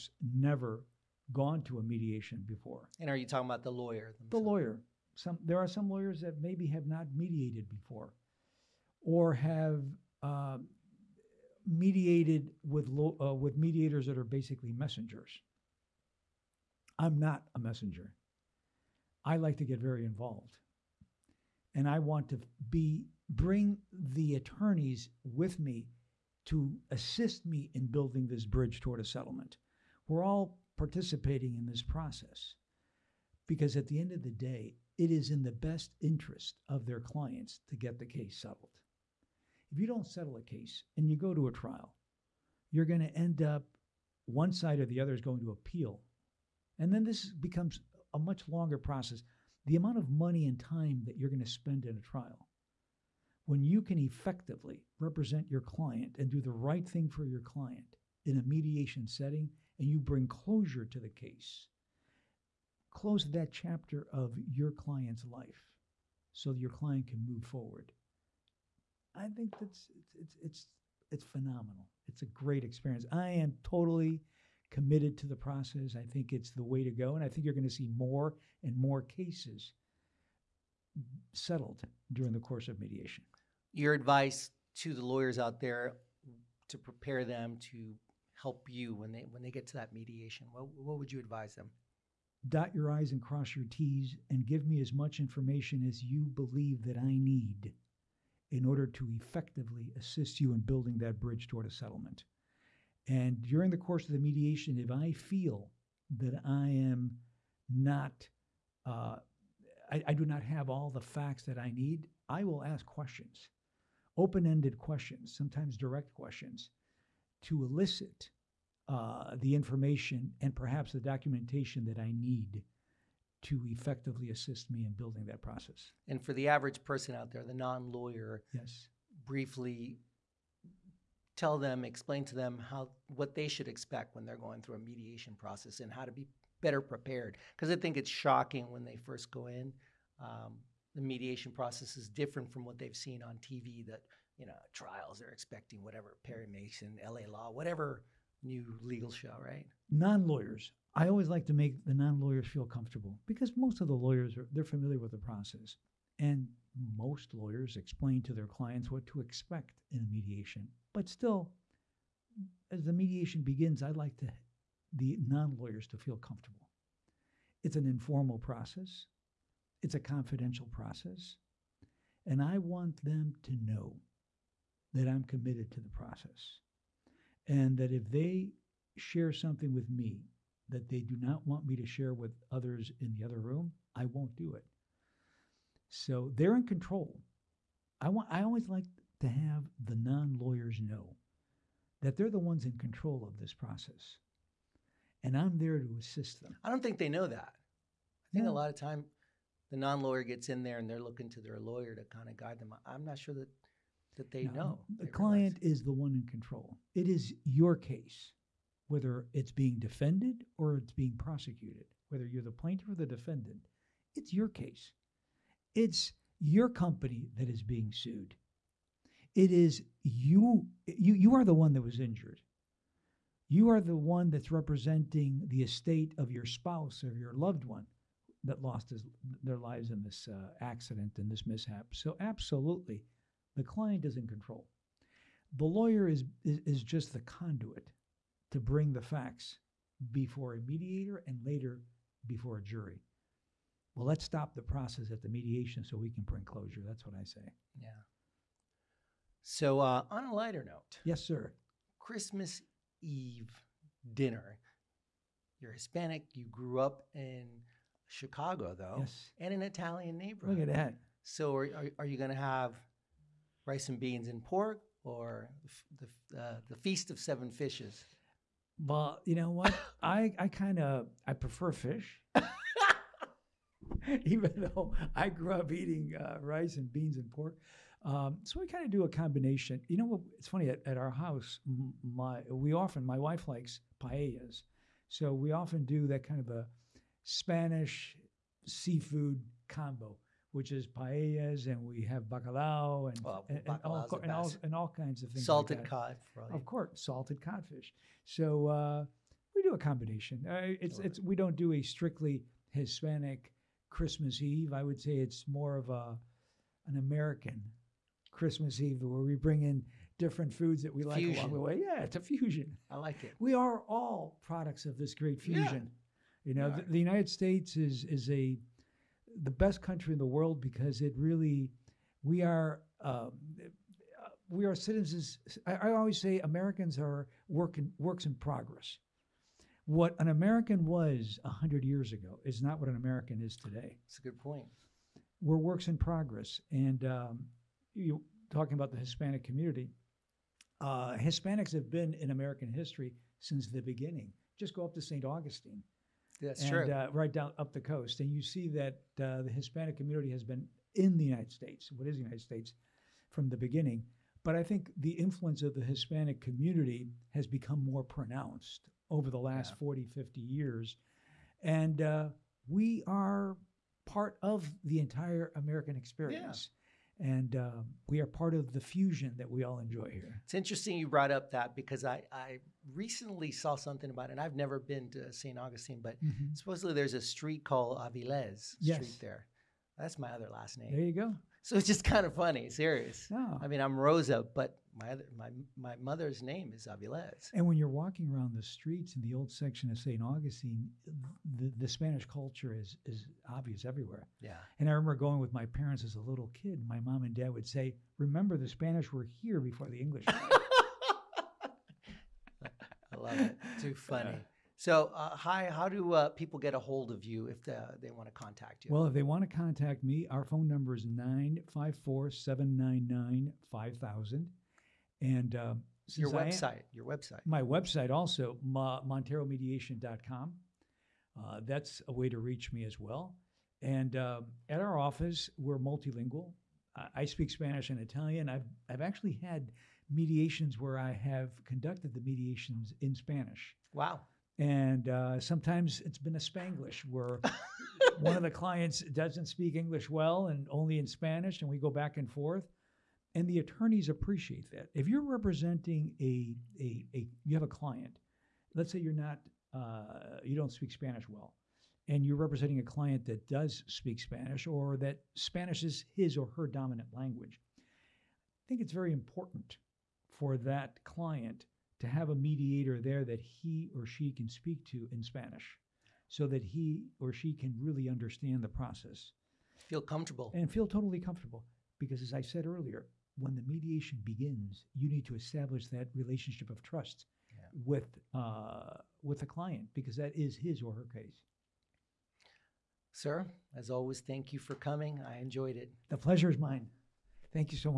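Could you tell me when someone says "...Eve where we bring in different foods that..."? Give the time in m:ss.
5:08.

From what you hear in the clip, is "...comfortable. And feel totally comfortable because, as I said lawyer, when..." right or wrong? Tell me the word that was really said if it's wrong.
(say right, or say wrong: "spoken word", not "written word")
wrong: "earlier", not "lawyer".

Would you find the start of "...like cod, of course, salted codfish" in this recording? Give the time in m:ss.
4:55.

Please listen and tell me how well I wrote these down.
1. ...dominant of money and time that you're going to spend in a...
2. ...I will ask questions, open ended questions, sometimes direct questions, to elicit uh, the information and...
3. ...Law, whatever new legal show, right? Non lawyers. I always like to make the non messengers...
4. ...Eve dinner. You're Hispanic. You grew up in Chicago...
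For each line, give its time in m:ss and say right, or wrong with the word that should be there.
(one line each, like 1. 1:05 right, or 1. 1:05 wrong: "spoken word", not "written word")
1. 0:49 wrong: "amount", not "dominant"
2. 1:52 right
3. 2:27 wrong: "lawyers", not "messengers"
4. 4:13 right.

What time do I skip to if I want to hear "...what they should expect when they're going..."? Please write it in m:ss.
2:13.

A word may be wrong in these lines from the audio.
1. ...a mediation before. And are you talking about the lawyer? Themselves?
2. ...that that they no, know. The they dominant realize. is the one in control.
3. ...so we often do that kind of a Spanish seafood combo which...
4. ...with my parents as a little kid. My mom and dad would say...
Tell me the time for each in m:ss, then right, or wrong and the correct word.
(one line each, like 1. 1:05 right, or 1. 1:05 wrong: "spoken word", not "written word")
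1. 0:01 right
2. 3:23 wrong: "client", not "dominant"
3. 4:45 right
4. 6:35 right.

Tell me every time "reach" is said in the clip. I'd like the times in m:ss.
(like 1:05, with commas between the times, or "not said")
7:02.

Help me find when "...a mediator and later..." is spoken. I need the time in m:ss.
4:00.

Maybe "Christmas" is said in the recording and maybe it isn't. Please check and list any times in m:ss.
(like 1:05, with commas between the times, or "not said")
4:11, 5:03, 5:08.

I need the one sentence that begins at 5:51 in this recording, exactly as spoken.
What is the United States from the beginning?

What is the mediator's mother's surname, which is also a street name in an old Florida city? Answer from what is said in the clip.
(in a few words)
Avilés.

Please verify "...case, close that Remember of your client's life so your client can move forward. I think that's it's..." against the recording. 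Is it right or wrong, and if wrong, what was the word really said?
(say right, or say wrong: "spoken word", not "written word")
wrong: "chapter", not "Remember".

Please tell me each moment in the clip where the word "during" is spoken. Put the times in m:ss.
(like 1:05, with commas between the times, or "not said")
1:22, 1:43.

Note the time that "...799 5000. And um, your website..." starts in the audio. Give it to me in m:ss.
6:52.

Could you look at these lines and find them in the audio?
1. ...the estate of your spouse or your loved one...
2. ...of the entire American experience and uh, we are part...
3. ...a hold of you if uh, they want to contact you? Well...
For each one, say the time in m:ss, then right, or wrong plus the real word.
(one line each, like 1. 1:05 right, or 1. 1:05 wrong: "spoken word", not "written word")
1. 3:45 right
2. 6:04 right
3. 6:46 right.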